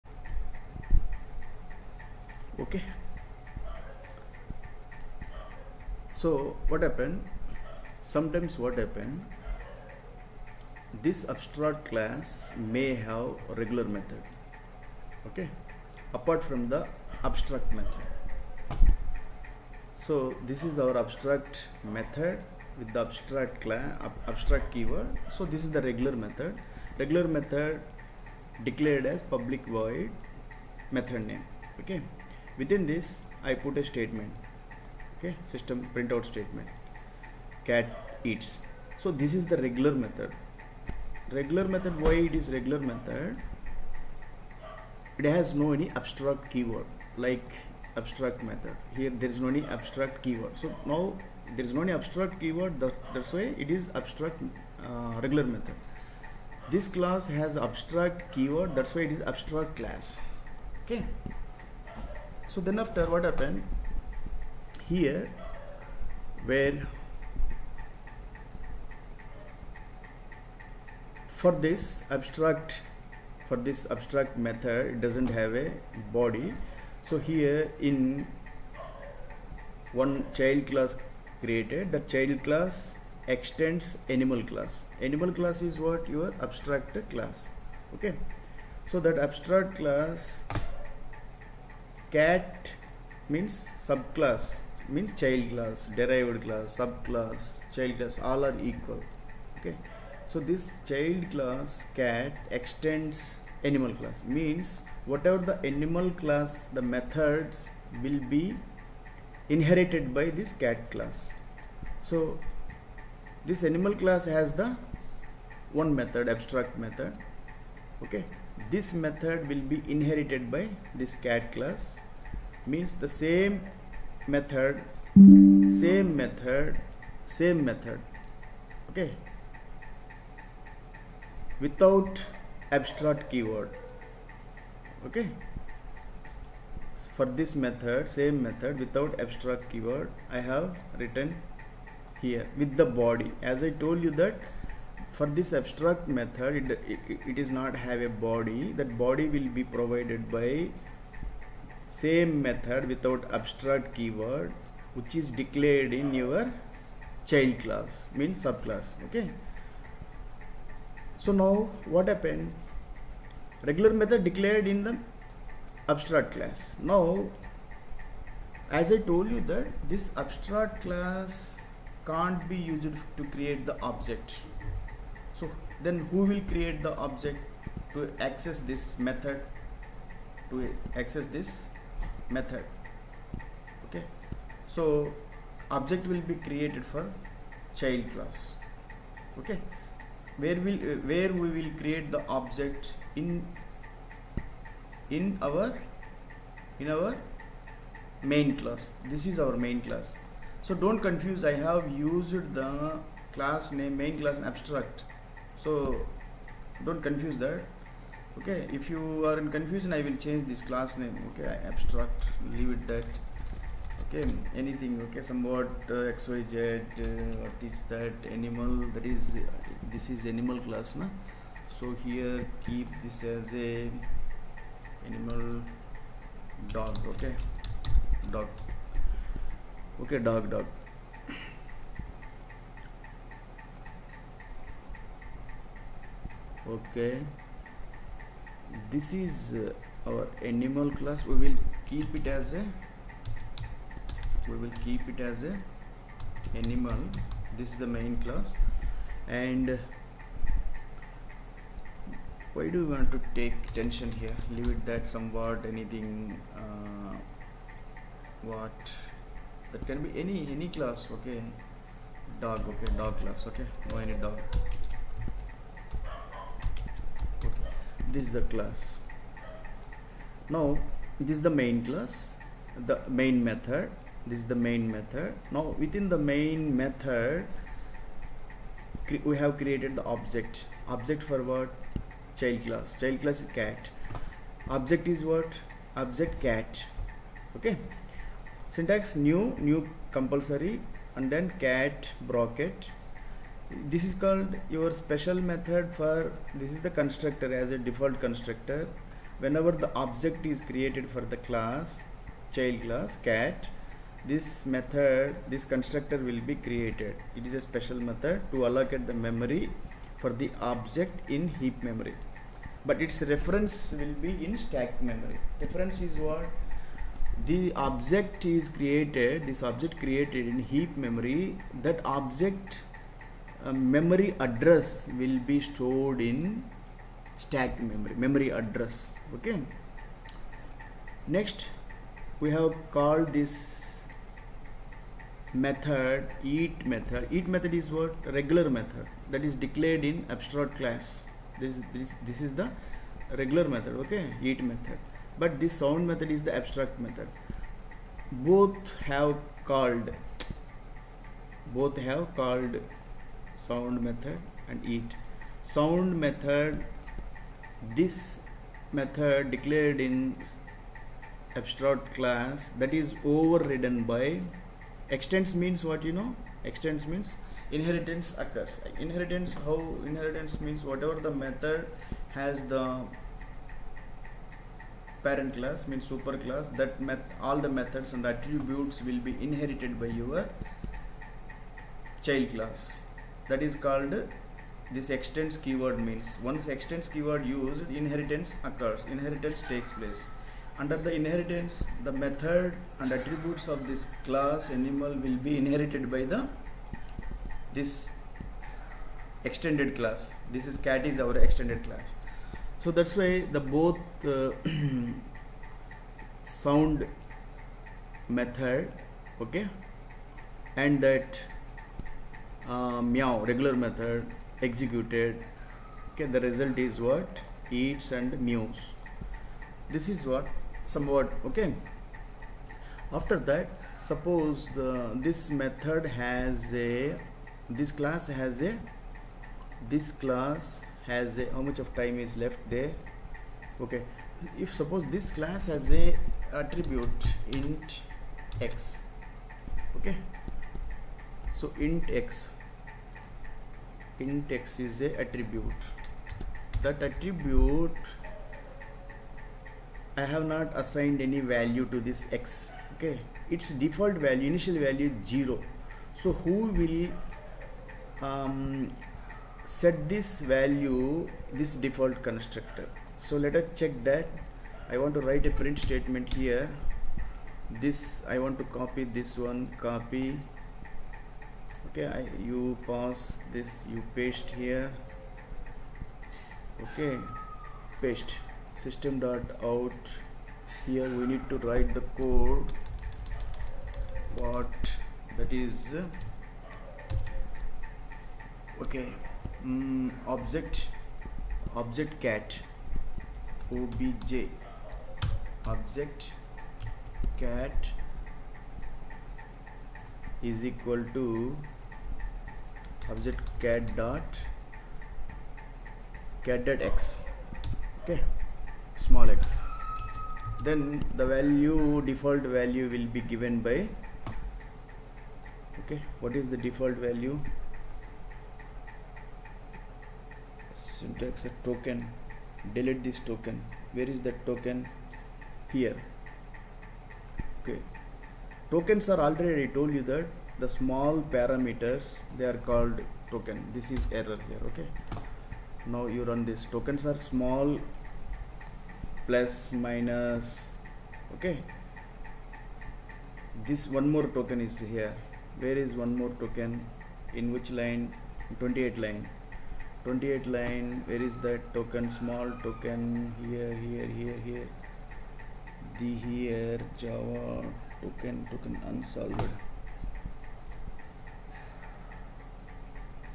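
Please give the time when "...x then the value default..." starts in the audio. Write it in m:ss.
8:29.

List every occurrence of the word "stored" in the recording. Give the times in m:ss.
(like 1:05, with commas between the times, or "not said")
5:25.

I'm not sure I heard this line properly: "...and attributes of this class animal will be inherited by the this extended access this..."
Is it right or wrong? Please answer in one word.
wrong.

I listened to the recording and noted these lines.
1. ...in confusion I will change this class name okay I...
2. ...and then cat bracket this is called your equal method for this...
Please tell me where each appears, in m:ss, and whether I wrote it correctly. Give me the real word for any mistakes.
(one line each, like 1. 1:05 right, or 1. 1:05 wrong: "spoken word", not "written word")
1. 3:29 right
2. 4:51 wrong: "special", not "equal".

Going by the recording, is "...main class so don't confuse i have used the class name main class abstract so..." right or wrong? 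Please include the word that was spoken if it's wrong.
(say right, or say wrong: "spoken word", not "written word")
right.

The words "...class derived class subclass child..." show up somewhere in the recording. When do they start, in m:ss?
1:35.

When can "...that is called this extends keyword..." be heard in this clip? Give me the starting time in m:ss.
6:23.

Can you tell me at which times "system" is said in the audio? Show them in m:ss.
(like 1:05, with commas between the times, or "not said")
0:35, 7:58.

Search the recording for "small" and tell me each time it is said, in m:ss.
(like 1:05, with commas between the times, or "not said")
8:28, 8:50, 8:57, 9:12.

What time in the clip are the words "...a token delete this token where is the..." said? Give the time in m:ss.
8:41.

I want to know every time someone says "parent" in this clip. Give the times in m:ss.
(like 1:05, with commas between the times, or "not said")
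6:15.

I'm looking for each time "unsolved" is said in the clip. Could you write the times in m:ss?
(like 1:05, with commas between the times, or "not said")
9:18.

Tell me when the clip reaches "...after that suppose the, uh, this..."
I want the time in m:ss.
7:03.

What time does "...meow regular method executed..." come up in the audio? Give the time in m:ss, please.
6:53.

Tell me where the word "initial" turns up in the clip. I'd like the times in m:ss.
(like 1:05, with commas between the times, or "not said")
7:34.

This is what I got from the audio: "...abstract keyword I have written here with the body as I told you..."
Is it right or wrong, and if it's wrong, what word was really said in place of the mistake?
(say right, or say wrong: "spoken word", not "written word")
right.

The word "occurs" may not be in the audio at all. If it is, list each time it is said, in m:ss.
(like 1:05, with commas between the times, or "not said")
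6:08, 6:28.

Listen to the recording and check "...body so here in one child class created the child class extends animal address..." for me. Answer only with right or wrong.
wrong.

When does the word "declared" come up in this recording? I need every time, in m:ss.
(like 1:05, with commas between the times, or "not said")
0:28, 2:35, 2:44, 5:39, 5:59.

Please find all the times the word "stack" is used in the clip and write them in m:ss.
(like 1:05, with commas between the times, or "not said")
5:14, 5:27.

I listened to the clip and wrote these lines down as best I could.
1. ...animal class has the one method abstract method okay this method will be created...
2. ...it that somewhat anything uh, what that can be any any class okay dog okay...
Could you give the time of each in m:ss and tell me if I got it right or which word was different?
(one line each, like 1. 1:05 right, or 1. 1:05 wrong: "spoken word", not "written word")
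1. 1:53 wrong: "inherited", not "created"
2. 4:14 right.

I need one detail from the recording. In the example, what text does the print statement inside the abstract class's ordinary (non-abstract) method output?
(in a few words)
cat eats.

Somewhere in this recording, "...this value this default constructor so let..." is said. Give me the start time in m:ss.
7:40.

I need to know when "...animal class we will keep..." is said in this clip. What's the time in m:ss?
4:00.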